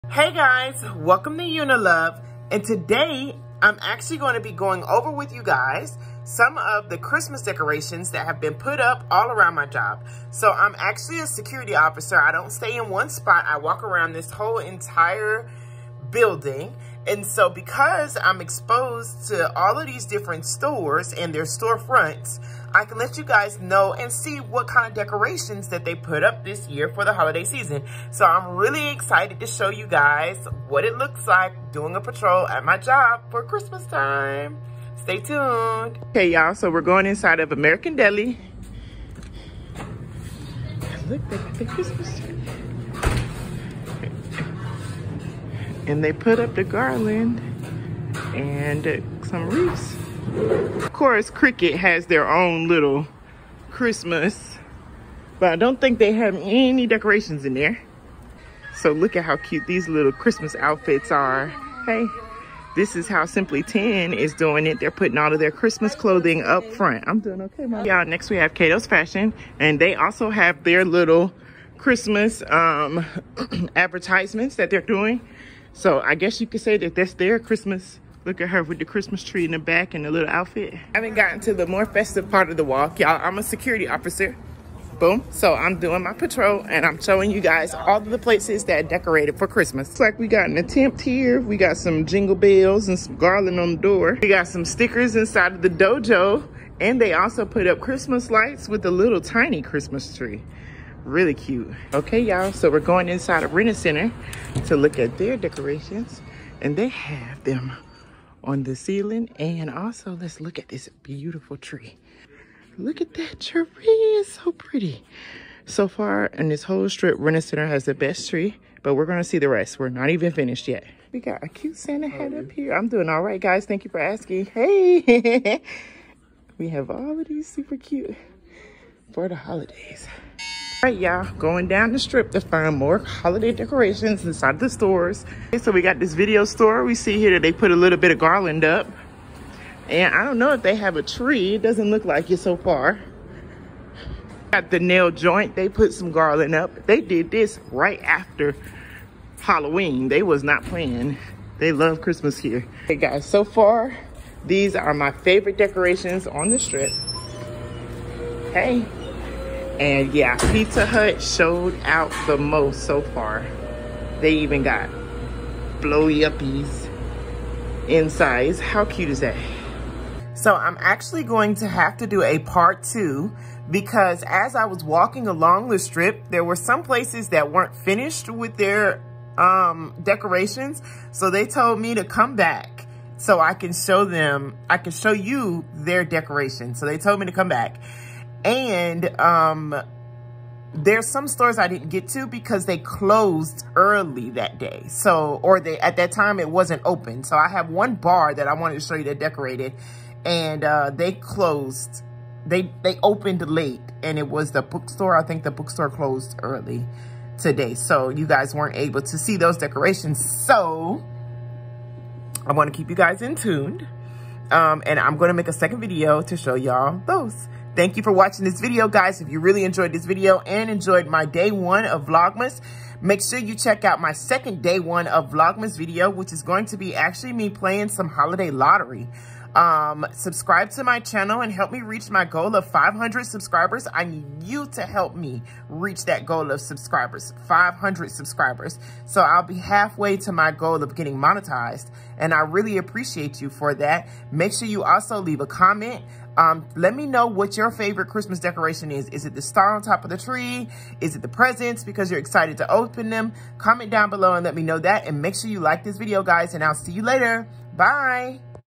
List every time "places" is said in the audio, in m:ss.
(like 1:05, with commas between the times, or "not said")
1:28, 2:56.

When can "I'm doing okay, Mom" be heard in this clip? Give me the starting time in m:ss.
1:07.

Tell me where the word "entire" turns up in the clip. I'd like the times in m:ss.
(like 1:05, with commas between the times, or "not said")
0:14.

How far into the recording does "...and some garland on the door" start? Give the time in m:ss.
1:32.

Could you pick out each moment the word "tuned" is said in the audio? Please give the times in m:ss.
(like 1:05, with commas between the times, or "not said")
0:35, 3:33.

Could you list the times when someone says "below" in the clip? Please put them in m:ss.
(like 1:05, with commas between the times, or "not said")
4:14.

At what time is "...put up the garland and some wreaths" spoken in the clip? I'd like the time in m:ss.
0:46.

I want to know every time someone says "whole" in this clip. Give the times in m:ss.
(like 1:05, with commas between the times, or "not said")
0:14, 1:56.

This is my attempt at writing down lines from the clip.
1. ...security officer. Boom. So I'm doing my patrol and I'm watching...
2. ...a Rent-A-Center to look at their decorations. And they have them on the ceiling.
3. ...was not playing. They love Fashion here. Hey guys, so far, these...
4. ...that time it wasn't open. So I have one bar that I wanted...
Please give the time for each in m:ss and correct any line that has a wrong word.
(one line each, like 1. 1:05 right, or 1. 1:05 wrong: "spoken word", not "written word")
1. 1:23 wrong: "showing", not "watching"
2. 1:43 right
3. 2:30 wrong: "Christmas", not "Fashion"
4. 3:15 right.